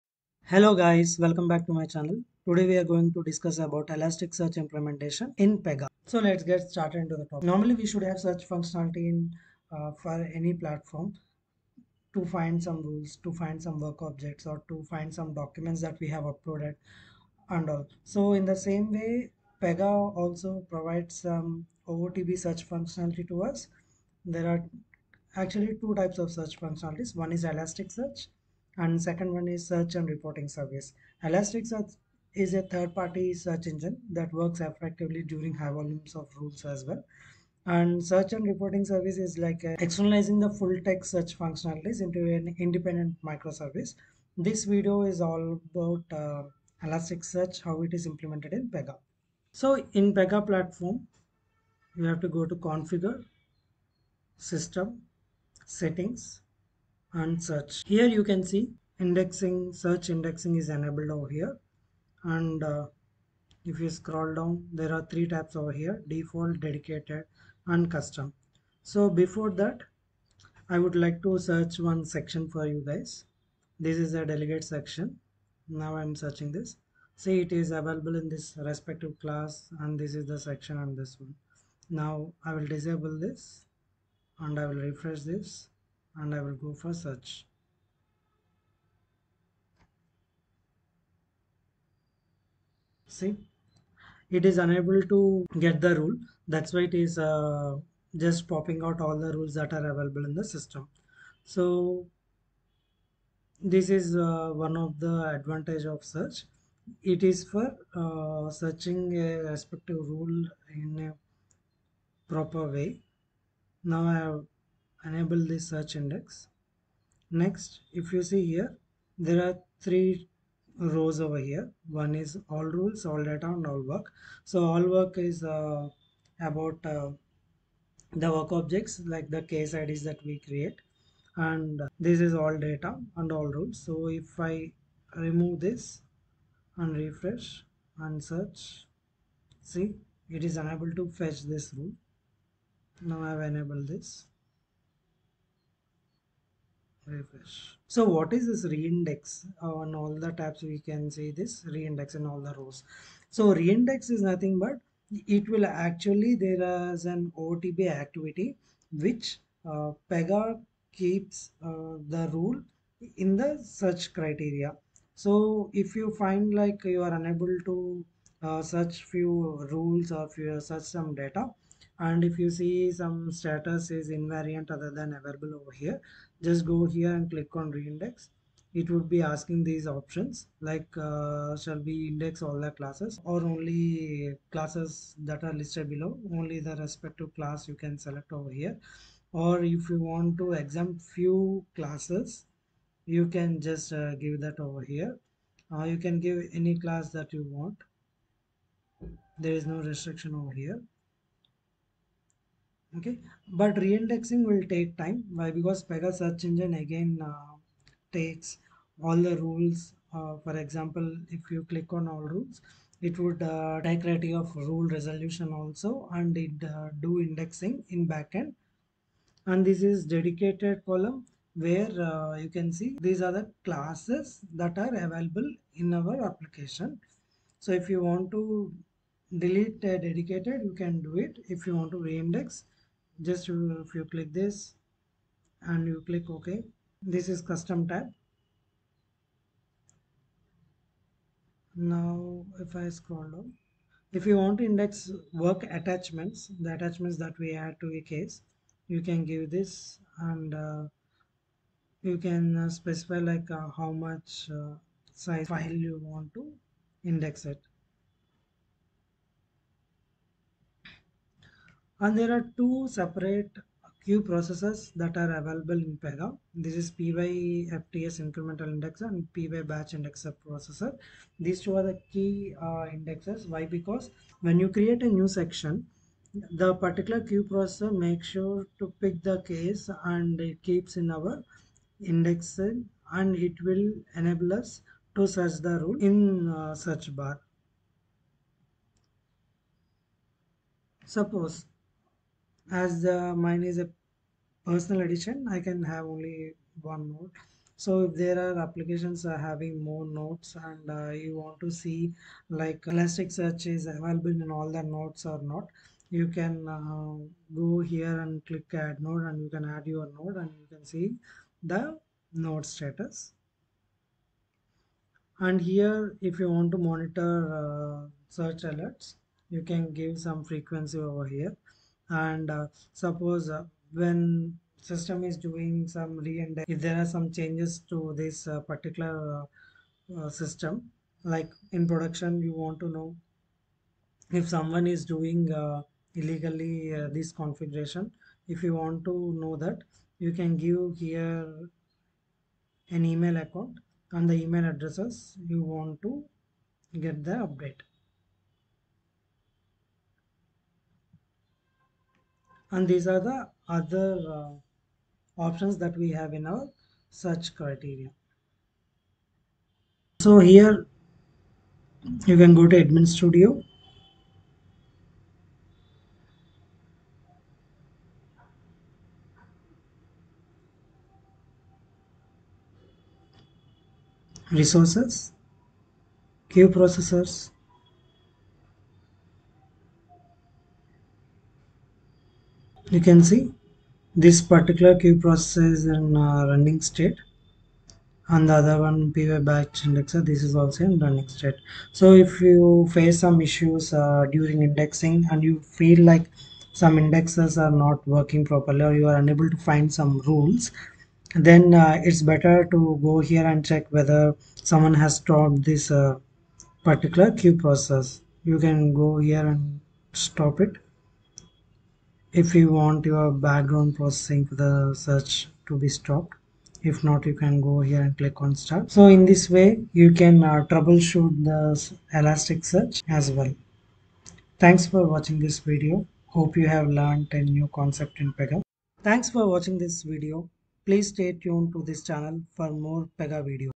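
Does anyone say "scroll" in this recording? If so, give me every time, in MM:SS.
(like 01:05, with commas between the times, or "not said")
01:03, 04:02.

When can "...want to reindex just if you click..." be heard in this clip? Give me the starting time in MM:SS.
03:51.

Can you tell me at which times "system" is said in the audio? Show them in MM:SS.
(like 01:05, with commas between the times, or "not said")
00:54, 01:40, 05:24, 05:30.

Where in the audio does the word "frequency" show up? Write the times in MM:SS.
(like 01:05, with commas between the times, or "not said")
05:20.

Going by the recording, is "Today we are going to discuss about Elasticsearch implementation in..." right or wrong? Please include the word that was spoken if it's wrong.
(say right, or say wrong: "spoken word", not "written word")
right.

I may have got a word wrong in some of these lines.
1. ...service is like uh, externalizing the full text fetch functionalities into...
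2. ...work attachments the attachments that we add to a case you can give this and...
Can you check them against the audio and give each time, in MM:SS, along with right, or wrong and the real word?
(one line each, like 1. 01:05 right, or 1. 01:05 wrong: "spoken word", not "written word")
1. 00:38 wrong: "search", not "fetch"
2. 04:05 right.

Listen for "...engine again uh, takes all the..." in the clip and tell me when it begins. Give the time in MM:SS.
03:26.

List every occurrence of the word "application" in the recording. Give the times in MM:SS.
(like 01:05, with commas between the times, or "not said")
03:46, 04:58.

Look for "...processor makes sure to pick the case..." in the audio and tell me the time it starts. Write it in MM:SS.
04:37.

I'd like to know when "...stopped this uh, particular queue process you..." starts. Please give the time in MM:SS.
06:45.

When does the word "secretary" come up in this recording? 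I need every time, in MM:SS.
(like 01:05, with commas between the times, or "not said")
not said.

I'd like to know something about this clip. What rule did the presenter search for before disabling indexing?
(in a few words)
Delegate section.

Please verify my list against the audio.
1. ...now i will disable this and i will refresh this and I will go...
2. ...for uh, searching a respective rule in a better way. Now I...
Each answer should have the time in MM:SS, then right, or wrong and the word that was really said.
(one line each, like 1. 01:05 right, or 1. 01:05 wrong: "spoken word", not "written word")
1. 01:21 right
2. 01:47 wrong: "proper", not "better".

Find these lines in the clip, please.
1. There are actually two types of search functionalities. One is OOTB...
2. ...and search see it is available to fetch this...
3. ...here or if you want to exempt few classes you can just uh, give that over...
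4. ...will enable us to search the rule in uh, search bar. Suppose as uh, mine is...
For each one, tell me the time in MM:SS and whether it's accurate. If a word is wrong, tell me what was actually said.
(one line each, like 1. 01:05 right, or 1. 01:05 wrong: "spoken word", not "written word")
1. 00:24 wrong: "Elasticsearch", not "OOTB"
2. 02:17 wrong: "unable", not "available"
3. 03:08 right
4. 04:43 right.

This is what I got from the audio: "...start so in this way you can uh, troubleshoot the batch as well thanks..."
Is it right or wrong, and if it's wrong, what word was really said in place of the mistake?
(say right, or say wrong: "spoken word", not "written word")
wrong: "elasticsearch", not "batch".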